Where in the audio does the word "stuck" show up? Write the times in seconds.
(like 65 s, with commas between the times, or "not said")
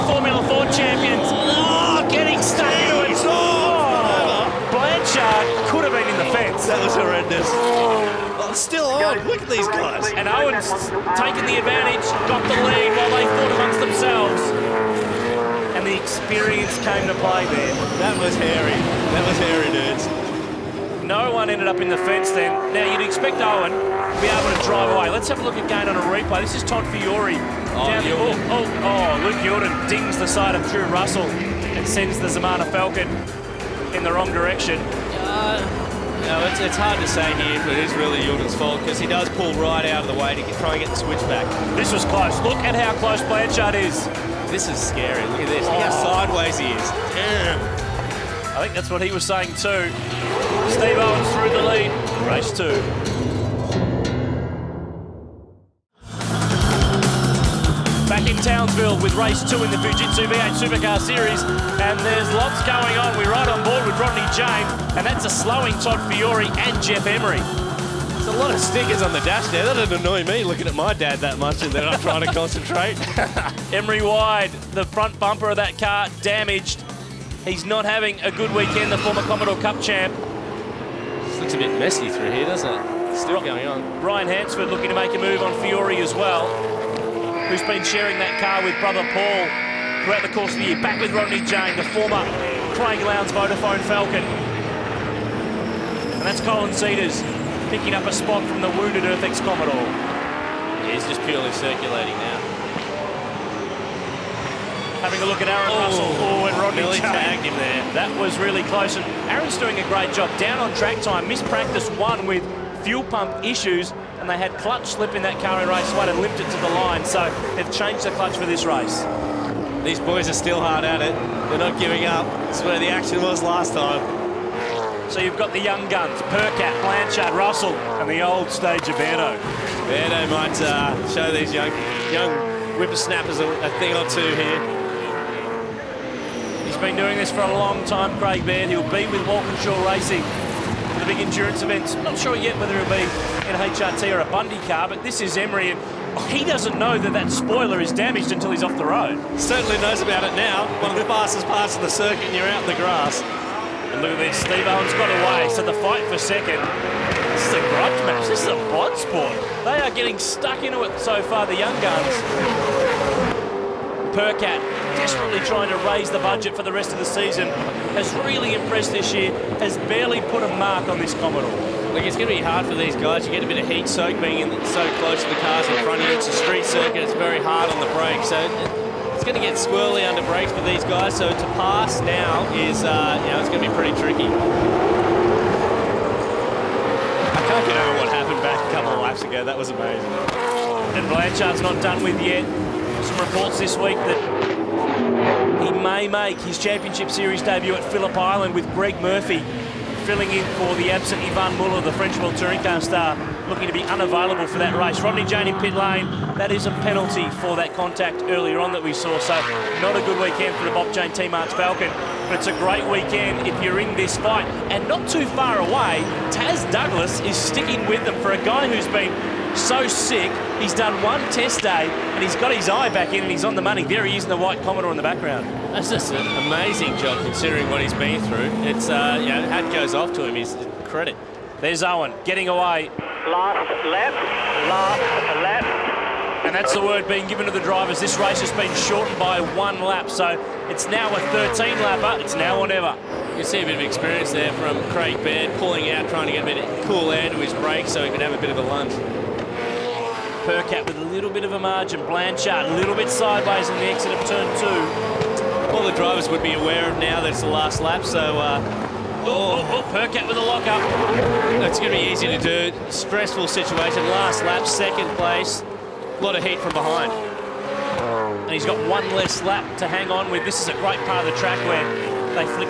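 2 s, 160 s.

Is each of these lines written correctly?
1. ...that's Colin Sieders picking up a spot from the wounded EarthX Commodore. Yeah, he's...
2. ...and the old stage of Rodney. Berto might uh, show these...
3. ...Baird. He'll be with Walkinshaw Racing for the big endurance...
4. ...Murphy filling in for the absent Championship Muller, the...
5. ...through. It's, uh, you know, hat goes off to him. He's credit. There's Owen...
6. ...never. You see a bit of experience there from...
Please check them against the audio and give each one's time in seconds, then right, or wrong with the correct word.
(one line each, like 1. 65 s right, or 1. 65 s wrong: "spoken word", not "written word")
1. 96 s right
2. 127 s wrong: "Berto", not "Rodney"
3. 138 s right
4. 199 s wrong: "Yvan", not "Championship"
5. 228 s right
6. 242 s right.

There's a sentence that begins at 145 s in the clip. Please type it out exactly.
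and He doesn't know that that spoiler is damaged until he's off the road.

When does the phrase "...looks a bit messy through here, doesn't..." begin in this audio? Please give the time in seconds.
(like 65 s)
81 s.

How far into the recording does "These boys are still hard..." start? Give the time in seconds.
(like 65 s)
119 s.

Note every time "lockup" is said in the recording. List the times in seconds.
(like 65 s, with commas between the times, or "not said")
260 s.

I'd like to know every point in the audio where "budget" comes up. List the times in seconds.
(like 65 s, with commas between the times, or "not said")
166 s.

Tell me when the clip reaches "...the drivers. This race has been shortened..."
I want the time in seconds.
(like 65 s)
237 s.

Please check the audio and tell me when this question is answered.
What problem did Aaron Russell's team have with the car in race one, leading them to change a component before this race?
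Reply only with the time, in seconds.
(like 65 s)
114 s.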